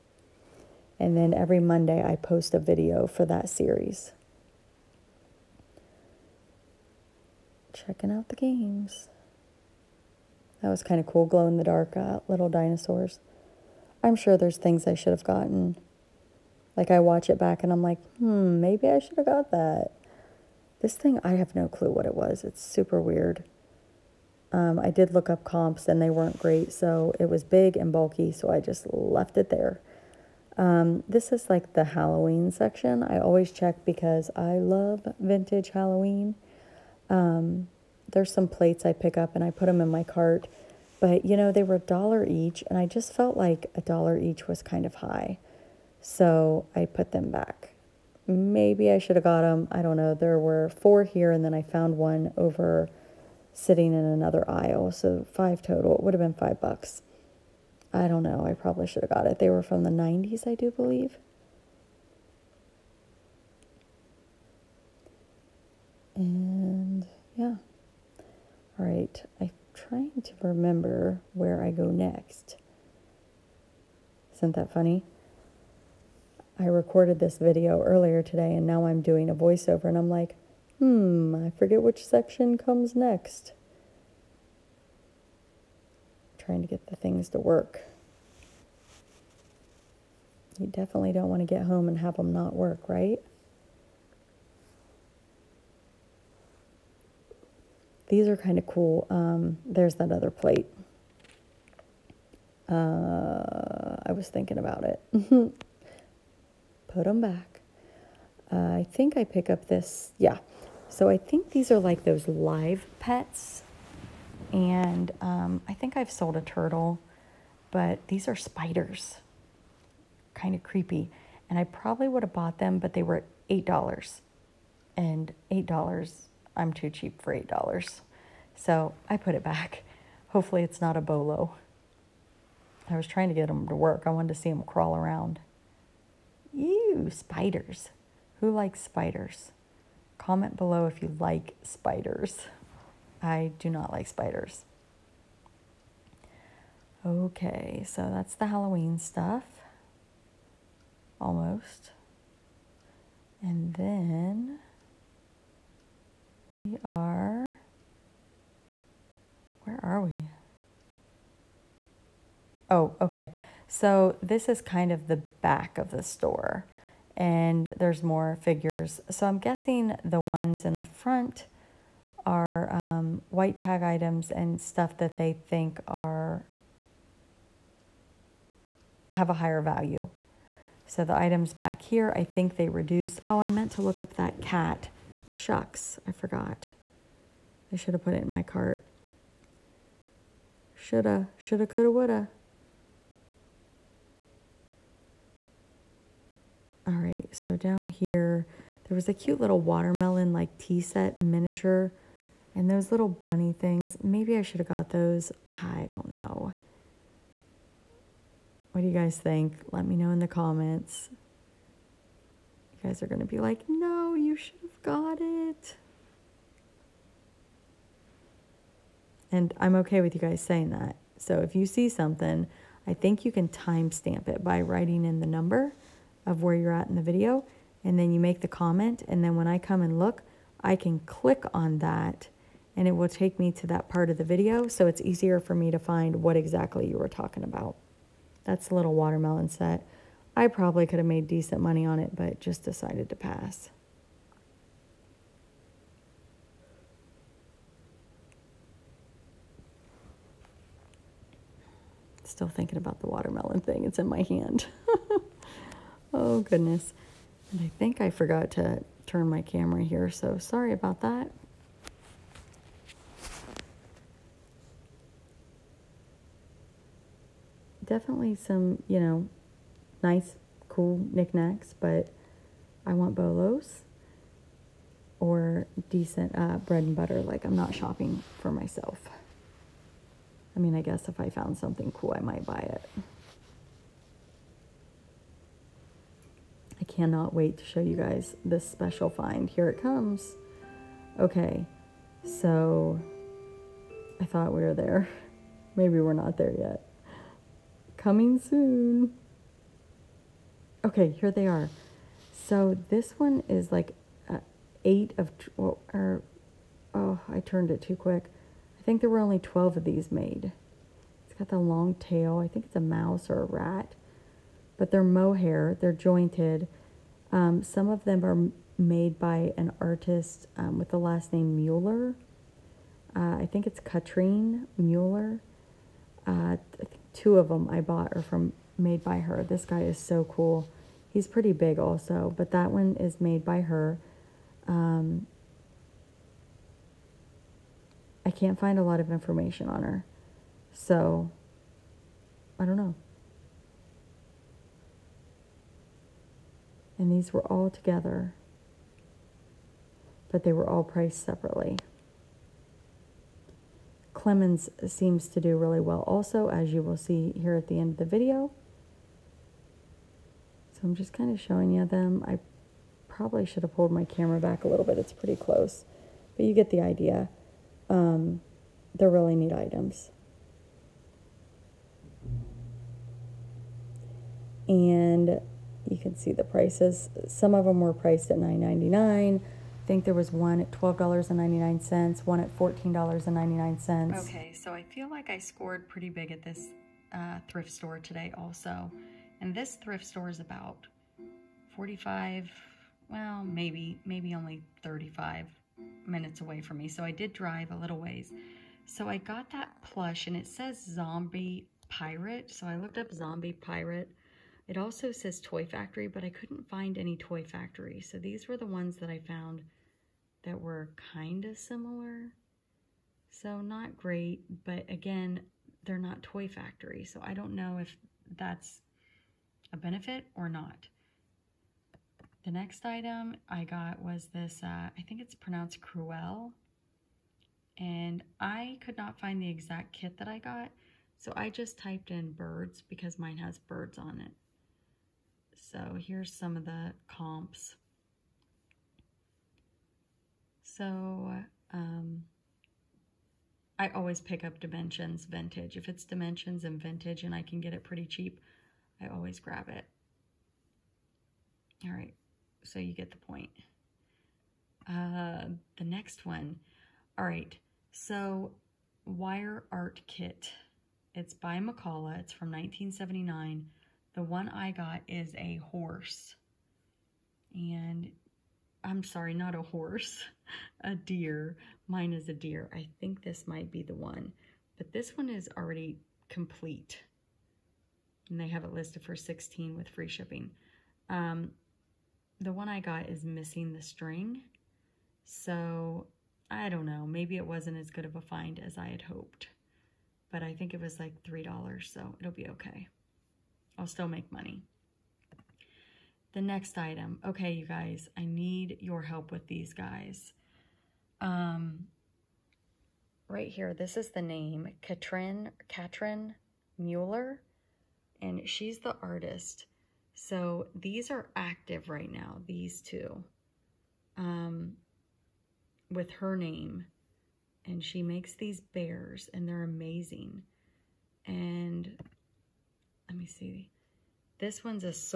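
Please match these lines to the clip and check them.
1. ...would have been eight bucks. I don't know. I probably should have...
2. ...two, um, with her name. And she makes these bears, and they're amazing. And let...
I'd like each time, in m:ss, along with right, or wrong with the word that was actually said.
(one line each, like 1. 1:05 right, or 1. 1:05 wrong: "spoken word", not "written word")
1. 0:56 wrong: "five", not "eight"
2. 8:32 right.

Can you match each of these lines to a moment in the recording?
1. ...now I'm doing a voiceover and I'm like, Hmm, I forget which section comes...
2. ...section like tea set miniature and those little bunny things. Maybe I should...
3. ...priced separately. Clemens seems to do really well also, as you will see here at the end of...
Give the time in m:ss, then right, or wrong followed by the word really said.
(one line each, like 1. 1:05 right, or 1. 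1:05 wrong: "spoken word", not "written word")
1. 1:18 right
2. 3:19 wrong: "watermelon", not "section"
3. 5:50 right.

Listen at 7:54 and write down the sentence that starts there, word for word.
But this one is already complete.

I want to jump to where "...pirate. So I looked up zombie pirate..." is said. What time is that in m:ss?
6:41.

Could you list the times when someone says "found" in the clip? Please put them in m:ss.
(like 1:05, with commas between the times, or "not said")
0:51, 4:41, 6:49.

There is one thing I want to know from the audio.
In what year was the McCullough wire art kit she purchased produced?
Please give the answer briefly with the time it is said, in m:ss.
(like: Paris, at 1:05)
1979, at 7:42.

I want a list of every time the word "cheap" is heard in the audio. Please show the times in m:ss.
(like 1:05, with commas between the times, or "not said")
2:06, 7:28.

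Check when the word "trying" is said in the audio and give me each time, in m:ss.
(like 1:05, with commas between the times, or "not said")
1:09, 1:26, 2:13.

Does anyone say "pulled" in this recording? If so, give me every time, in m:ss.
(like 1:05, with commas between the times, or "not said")
6:03.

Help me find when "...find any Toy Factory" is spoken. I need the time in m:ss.
6:46.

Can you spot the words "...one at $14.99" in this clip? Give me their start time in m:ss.
6:22.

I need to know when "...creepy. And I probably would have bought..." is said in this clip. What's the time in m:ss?
2:00.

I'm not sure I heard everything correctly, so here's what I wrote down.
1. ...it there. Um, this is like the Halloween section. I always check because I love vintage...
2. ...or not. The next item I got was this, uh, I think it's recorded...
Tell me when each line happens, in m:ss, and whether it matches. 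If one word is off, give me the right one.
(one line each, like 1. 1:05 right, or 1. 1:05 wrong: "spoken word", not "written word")
1. 0:29 right
2. 7:00 wrong: "pronounced", not "recorded".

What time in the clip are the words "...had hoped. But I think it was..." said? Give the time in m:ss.
8:08.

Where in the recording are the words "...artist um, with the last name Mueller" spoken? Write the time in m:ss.
5:19.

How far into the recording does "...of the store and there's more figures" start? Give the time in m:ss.
2:45.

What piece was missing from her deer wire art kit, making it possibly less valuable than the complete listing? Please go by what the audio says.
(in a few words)
The string.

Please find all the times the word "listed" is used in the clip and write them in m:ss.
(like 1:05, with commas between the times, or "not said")
7:58.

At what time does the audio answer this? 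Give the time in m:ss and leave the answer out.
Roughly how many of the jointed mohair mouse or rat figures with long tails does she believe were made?
5:09.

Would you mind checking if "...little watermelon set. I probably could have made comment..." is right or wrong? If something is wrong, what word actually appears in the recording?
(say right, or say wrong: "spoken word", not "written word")
wrong: "decent", not "comment".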